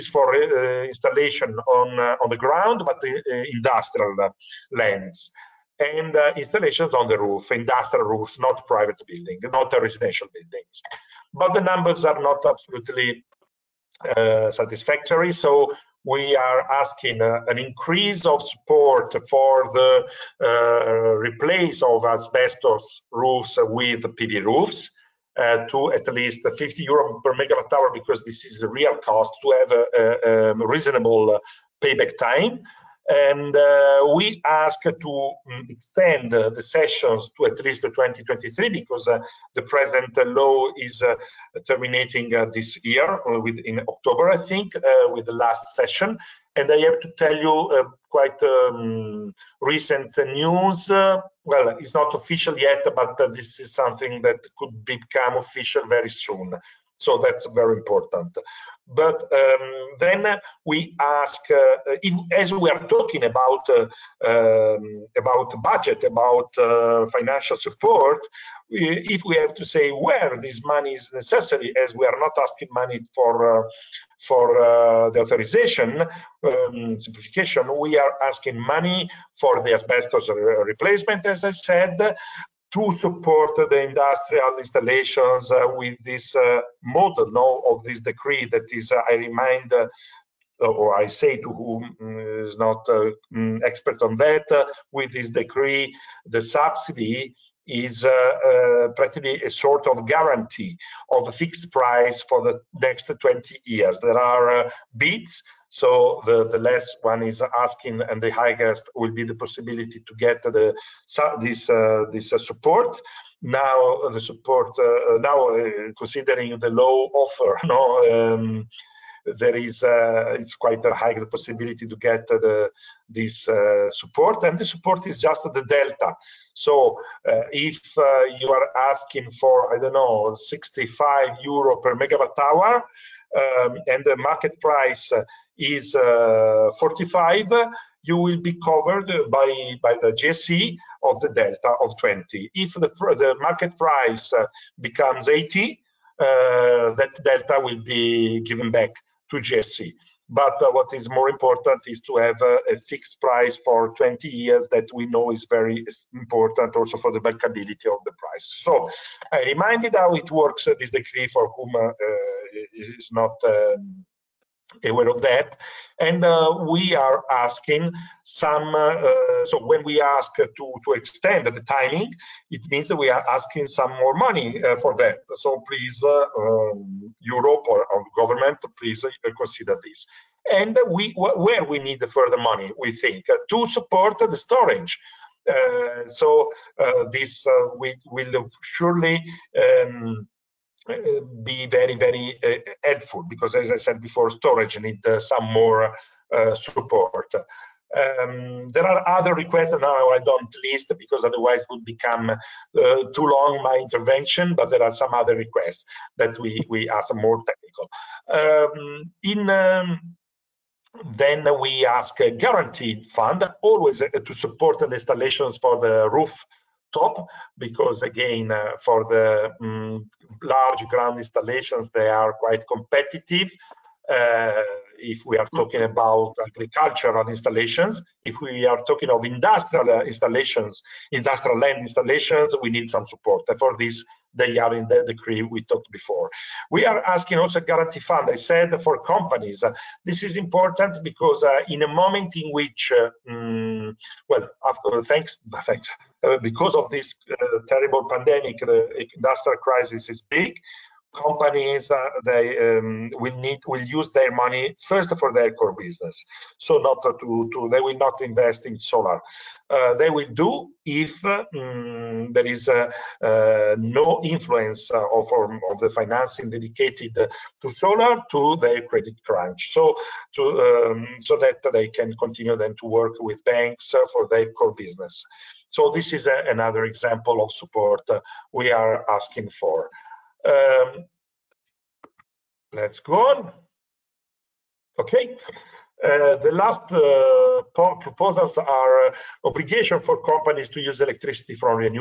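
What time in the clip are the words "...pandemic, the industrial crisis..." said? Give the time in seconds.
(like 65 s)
248 s.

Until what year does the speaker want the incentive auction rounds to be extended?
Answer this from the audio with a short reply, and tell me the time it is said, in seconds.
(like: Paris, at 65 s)
2023, at 37 s.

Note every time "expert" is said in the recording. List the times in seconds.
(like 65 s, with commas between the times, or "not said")
93 s.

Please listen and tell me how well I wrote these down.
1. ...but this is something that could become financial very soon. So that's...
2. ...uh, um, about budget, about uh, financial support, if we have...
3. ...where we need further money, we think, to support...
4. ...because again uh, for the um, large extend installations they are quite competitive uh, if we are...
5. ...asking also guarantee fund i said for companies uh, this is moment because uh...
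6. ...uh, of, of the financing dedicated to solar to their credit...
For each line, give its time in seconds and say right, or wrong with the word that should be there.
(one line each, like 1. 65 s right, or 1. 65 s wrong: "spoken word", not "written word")
1. 52 s wrong: "official", not "financial"
2. 63 s right
3. 181 s right
4. 217 s wrong: "ground", not "extend"
5. 237 s wrong: "important", not "moment"
6. 264 s right.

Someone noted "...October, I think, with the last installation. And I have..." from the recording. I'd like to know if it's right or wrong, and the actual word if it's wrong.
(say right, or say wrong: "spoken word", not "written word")
wrong: "session", not "installation".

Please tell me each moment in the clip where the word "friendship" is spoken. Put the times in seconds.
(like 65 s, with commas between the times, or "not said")
not said.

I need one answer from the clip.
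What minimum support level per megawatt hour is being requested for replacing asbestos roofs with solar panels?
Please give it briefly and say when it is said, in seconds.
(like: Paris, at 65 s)
50 euro, at 26 s.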